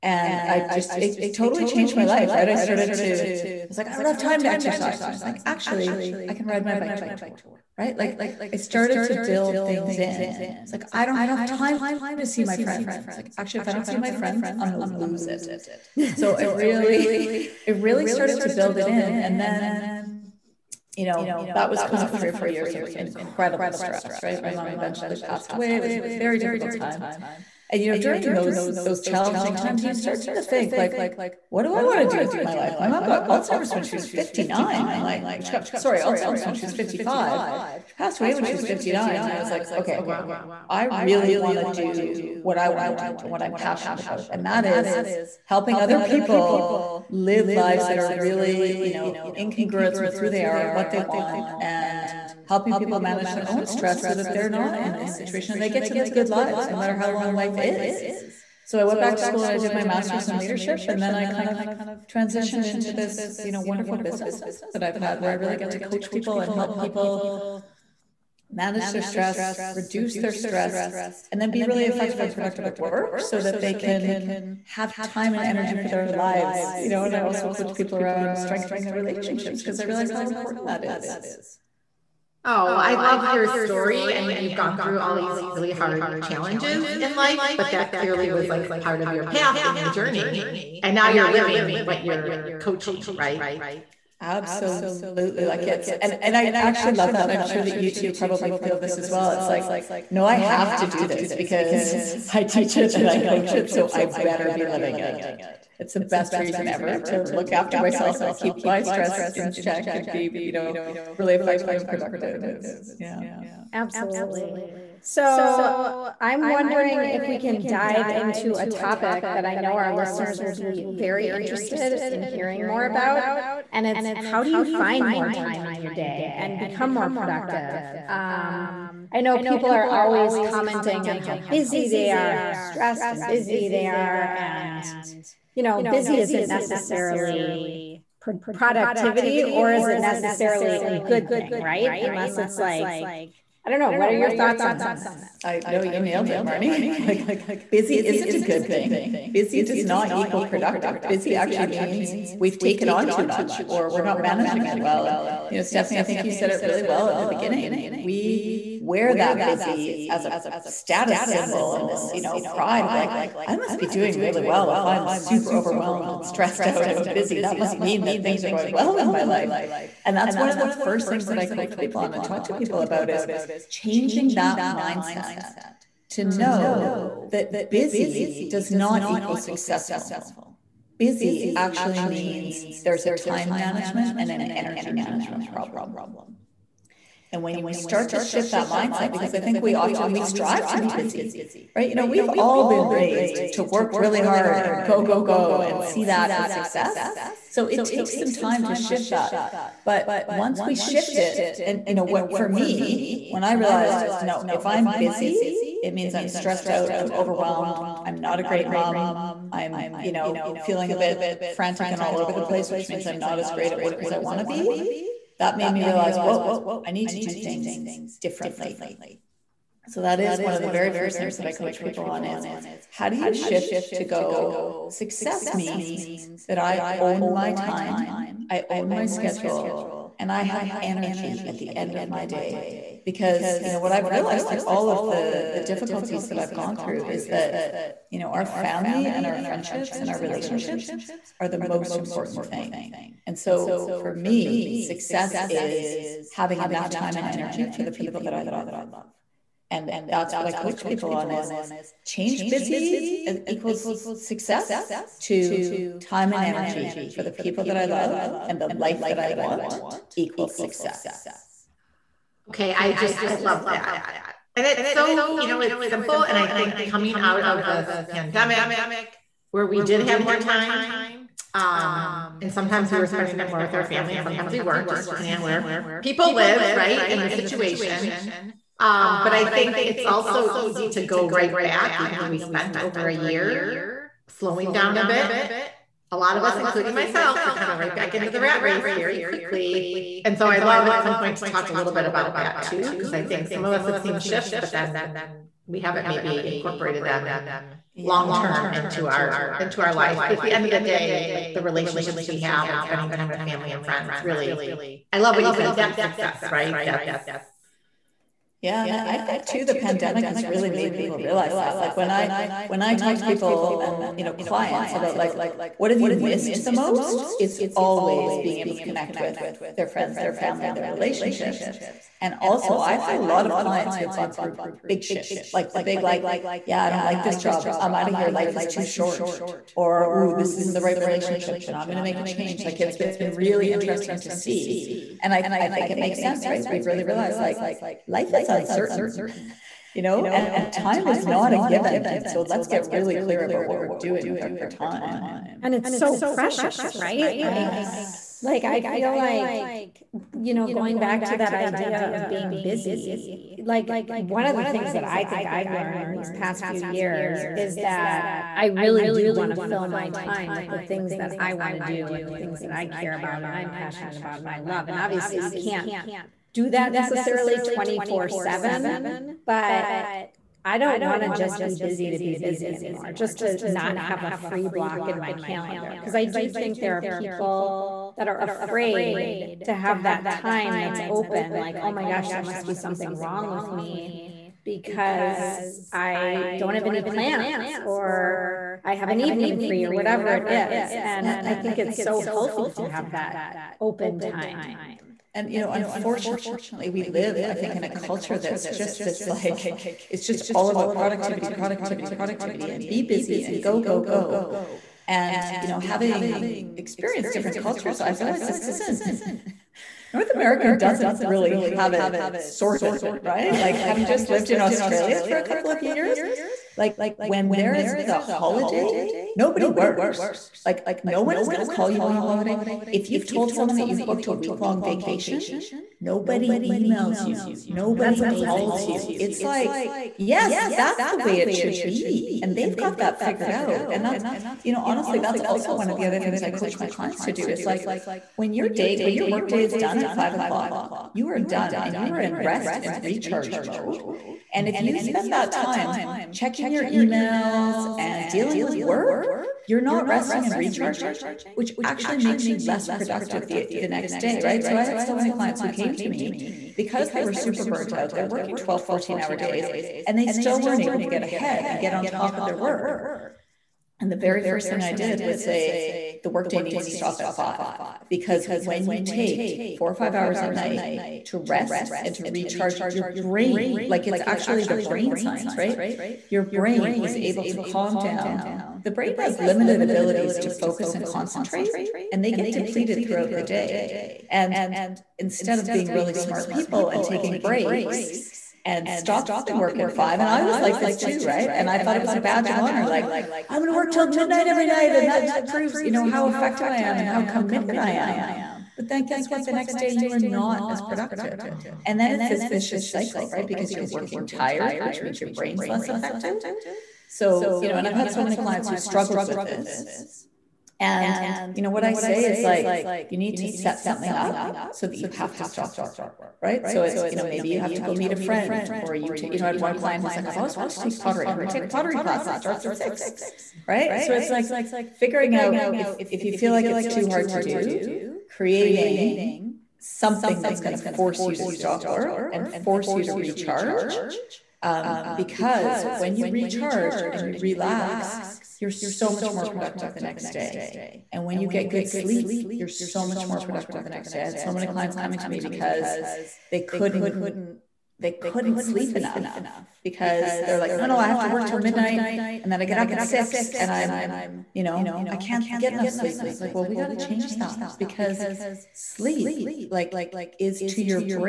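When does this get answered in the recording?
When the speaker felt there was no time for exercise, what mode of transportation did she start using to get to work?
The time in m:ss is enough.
0:06.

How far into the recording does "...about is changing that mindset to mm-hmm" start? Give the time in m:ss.
2:52.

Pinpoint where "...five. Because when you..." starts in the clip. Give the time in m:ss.
7:47.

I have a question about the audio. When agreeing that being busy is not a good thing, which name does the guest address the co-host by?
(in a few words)
Marnie.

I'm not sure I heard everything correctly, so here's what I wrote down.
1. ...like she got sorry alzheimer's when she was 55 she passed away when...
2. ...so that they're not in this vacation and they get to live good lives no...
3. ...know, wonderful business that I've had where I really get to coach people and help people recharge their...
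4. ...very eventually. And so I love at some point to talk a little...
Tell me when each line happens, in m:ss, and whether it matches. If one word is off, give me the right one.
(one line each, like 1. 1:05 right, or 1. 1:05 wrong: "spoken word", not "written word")
1. 0:34 right
2. 0:54 wrong: "situation", not "vacation"
3. 1:03 wrong: "manage", not "recharge"
4. 4:48 wrong: "quickly", not "eventually".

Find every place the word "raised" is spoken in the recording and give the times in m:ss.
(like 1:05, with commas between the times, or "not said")
3:12.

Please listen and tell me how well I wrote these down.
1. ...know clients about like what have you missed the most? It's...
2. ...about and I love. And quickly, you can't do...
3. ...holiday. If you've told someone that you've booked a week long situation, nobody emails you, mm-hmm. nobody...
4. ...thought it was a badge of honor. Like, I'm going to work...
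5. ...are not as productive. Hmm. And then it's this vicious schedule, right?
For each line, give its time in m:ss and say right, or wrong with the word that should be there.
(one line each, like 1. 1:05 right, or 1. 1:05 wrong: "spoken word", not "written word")
1. 5:14 right
2. 6:04 wrong: "obviously", not "quickly"
3. 7:02 wrong: "vacation", not "situation"
4. 8:11 right
5. 8:20 wrong: "cycle", not "schedule".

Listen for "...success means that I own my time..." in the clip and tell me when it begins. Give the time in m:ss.
3:44.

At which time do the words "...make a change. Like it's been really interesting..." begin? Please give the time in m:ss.
5:32.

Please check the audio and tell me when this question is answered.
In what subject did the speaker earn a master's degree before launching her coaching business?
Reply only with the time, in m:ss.
1:00.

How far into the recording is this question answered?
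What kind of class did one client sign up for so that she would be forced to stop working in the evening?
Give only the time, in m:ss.
8:41.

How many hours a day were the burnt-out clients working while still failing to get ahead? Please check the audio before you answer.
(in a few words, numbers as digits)
12 to 14.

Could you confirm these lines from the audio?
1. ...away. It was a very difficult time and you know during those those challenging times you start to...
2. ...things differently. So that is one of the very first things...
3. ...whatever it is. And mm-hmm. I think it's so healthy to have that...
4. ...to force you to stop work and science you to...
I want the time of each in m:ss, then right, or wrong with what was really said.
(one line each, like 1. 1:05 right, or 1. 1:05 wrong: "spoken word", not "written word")
1. 0:25 right
2. 3:37 right
3. 6:29 right
4. 8:50 wrong: "force", not "science".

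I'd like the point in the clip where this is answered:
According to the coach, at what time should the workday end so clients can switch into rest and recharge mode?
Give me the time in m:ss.
7:20.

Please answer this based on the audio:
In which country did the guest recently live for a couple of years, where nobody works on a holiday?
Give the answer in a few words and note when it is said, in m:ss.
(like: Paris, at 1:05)
Australia, at 6:54.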